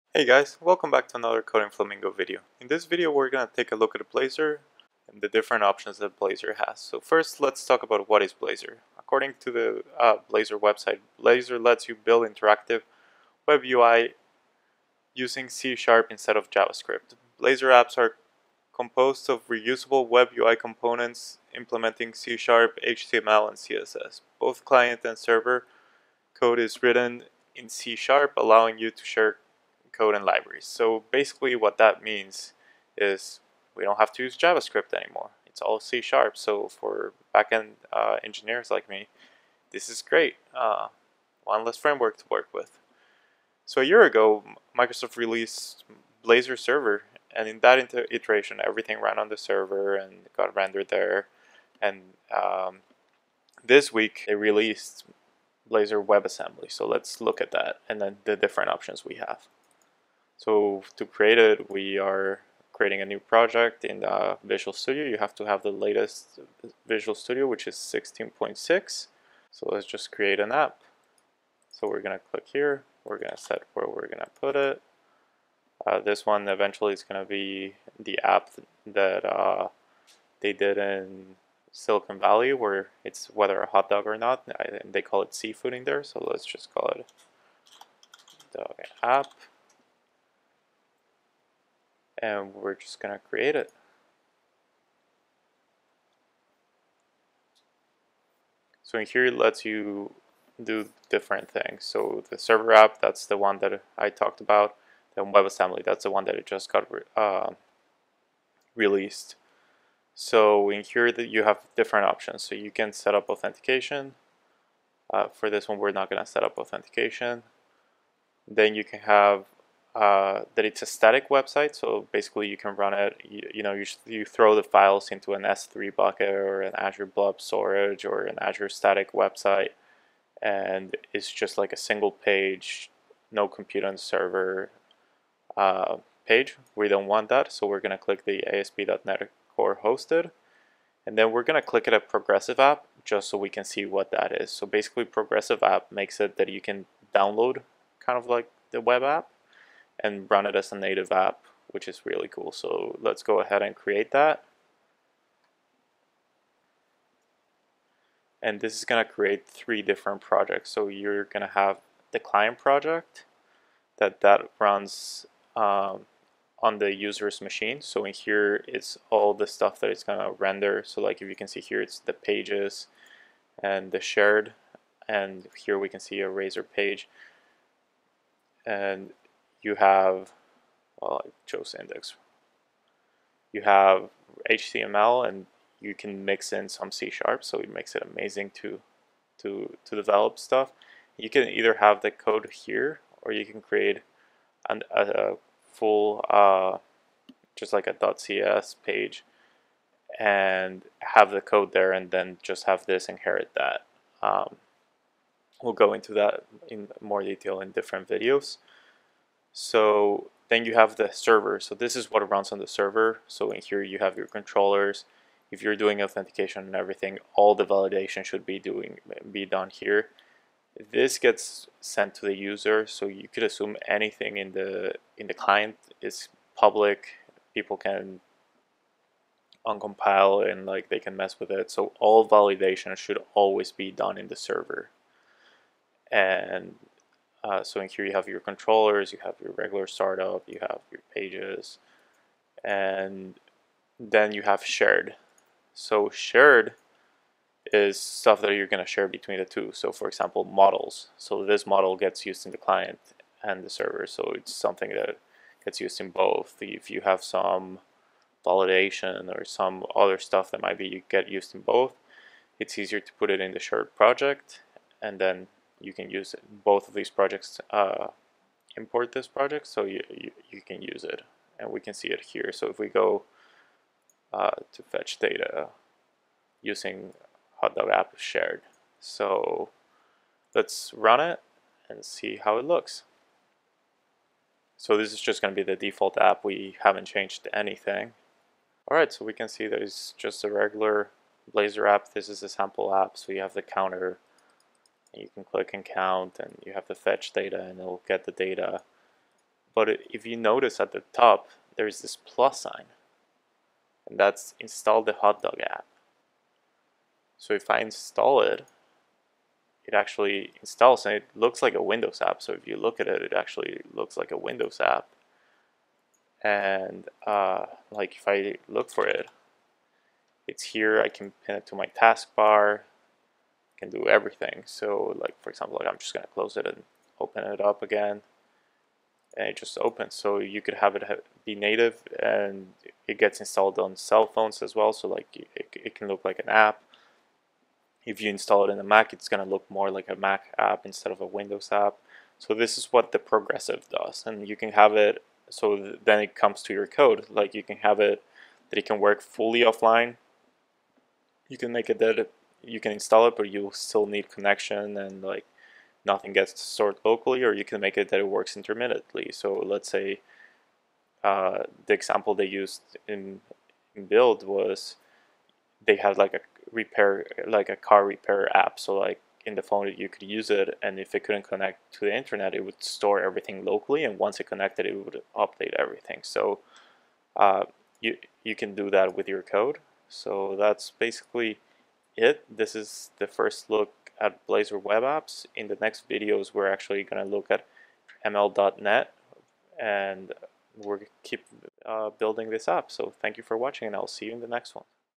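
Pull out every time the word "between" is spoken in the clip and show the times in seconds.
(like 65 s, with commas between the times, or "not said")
249 s.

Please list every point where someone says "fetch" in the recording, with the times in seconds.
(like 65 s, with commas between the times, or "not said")
274 s, 296 s.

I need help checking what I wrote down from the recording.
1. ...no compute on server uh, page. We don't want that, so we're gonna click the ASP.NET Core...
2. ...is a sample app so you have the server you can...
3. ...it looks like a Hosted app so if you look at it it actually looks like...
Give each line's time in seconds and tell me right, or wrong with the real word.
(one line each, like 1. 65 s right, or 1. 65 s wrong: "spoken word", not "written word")
1. 133 s right
2. 292 s wrong: "counter", not "server"
3. 311 s wrong: "Windows", not "Hosted".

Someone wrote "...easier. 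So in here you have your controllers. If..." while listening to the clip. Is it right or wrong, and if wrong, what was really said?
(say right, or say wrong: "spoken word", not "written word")
wrong: "server", not "easier".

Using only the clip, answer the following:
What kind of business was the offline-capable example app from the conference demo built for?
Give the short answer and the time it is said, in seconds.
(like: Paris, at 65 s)
car repair, at 367 s.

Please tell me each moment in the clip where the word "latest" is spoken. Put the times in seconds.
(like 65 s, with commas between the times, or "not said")
65 s.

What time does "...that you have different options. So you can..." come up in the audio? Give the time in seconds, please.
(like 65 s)
111 s.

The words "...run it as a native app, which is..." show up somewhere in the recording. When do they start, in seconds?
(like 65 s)
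150 s.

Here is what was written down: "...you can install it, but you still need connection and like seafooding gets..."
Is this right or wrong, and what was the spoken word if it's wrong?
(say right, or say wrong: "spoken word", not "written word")
wrong: "nothing", not "seafooding".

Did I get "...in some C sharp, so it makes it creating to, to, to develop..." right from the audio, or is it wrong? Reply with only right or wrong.
wrong.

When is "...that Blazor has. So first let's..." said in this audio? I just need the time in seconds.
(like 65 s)
5 s.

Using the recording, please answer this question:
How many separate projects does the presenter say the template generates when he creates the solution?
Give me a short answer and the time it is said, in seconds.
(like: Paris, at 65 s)
3, at 159 s.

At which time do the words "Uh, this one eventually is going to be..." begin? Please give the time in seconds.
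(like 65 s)
75 s.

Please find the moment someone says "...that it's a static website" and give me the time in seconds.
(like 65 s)
120 s.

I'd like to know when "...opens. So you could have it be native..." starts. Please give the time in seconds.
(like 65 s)
329 s.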